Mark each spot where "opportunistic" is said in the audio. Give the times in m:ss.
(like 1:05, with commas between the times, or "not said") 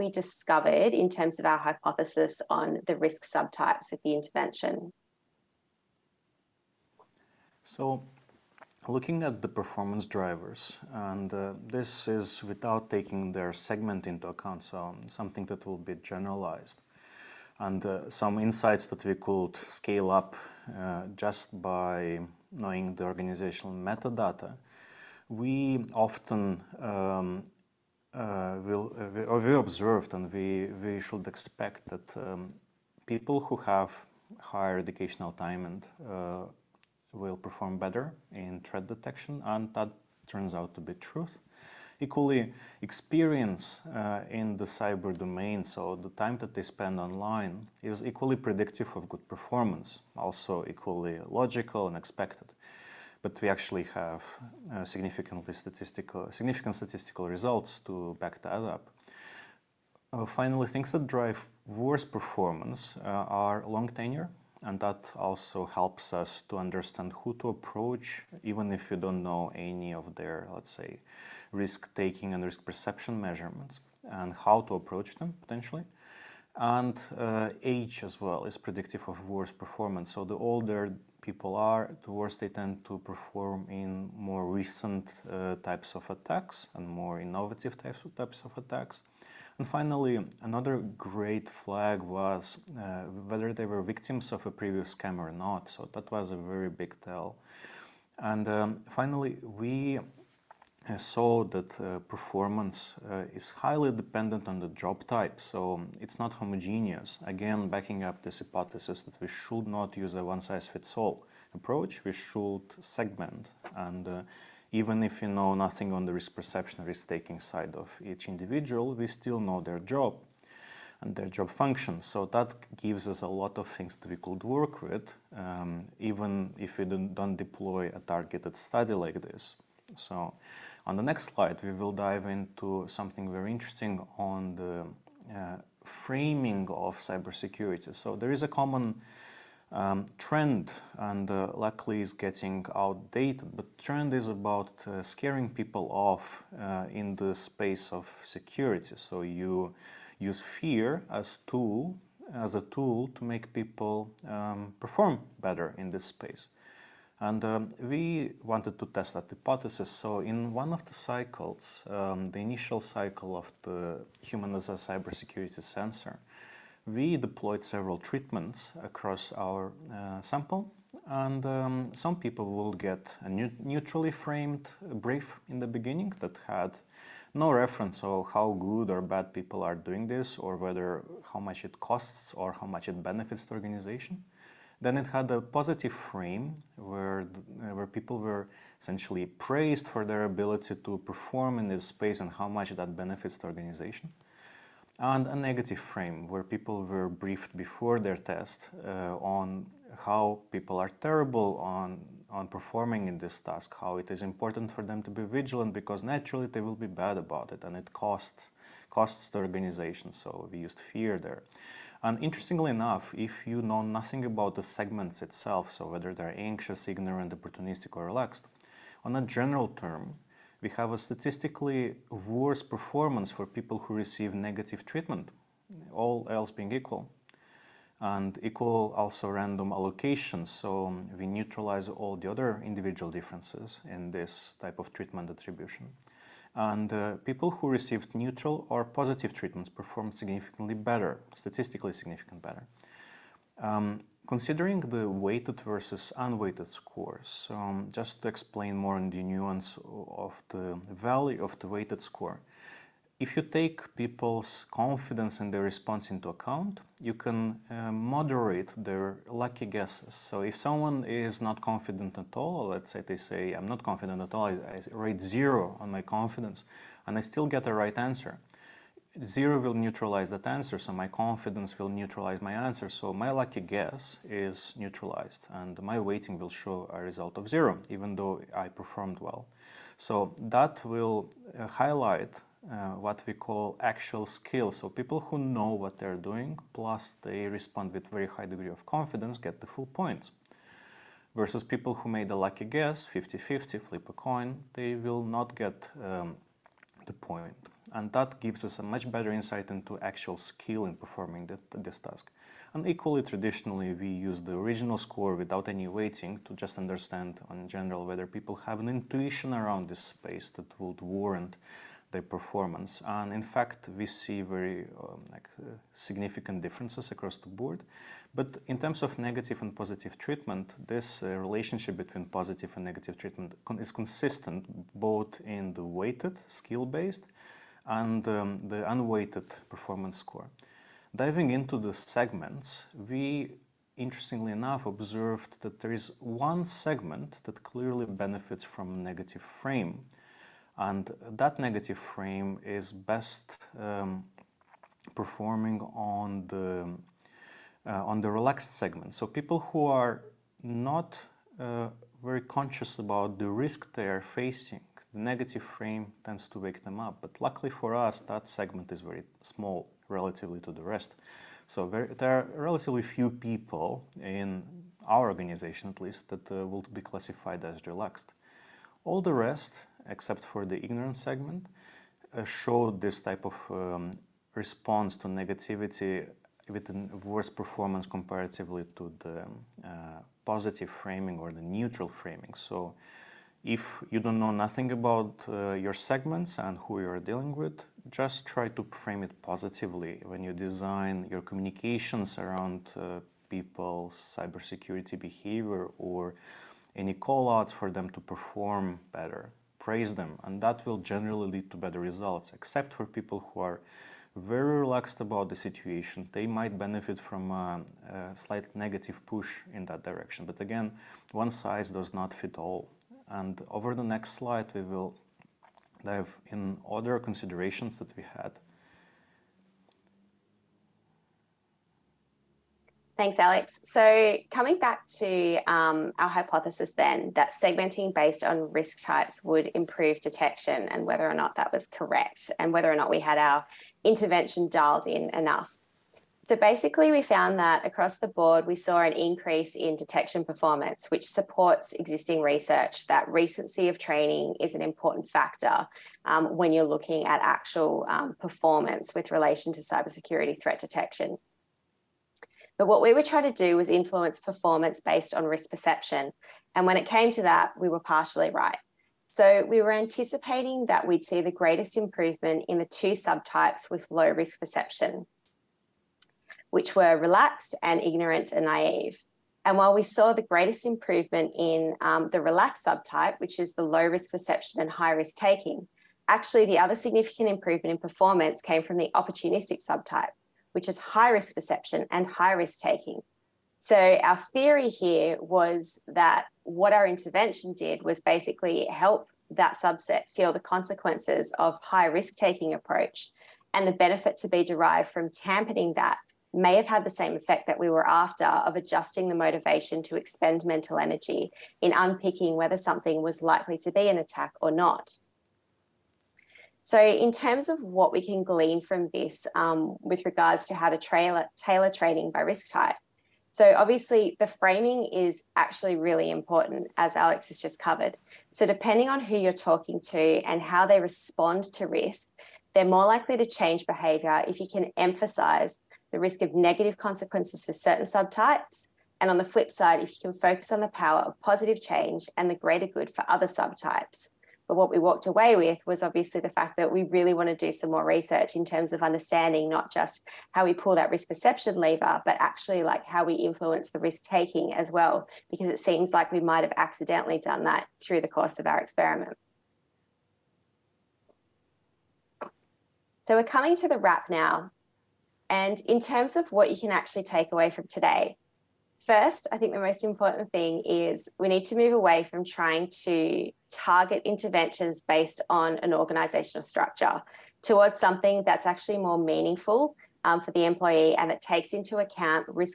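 3:37, 7:59.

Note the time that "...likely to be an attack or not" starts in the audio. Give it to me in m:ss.
8:23.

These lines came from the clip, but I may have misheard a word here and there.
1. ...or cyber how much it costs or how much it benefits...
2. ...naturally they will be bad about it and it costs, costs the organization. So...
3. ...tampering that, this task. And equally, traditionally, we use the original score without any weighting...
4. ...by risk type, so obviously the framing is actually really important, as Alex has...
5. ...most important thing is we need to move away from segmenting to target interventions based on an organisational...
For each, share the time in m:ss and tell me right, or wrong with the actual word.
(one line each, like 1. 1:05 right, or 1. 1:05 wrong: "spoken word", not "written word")
1. 3:00 wrong: "whether", not "cyber"
2. 3:26 right
3. 5:00 wrong: "performing", not "tampering"
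4. 8:32 right
5. 9:19 wrong: "trying", not "segmenting".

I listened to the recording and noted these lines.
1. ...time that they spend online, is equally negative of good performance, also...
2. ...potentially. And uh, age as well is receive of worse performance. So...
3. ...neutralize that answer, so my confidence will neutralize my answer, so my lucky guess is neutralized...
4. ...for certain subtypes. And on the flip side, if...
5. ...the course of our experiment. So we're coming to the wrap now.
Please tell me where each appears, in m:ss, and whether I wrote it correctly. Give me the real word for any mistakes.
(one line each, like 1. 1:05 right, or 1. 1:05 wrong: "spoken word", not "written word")
1. 0:46 wrong: "predictive", not "negative"
2. 1:15 wrong: "predictive", not "receive"
3. 4:29 right
4. 8:47 right
5. 9:08 right.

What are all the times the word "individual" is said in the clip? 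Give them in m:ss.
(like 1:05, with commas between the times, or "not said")
1:58, 3:52.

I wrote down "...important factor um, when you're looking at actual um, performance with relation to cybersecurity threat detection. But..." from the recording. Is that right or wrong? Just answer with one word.
right.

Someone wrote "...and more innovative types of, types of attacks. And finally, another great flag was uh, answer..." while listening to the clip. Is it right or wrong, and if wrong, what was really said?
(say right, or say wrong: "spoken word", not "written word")
wrong: "whether", not "answer".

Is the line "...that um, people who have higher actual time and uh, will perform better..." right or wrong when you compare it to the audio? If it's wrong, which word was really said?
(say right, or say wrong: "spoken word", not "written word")
wrong: "educational", not "actual".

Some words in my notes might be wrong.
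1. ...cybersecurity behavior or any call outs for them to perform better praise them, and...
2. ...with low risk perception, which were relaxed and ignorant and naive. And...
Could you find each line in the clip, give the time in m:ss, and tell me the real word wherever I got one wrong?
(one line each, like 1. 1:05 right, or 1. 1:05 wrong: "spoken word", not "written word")
1. 6:34 right
2. 7:43 right.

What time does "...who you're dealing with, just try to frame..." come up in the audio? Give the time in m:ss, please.
6:26.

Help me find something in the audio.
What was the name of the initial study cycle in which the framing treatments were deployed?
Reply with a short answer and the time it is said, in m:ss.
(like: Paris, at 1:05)
Human as a cybersecurity sensor, at 2:44.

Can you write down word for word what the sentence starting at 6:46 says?
They might benefit from a, a slight negative push in that direction.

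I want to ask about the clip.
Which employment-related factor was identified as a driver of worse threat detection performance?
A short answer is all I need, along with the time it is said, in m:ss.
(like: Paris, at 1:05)
Long tenure, at 1:03.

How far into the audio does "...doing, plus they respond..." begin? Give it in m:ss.
4:46.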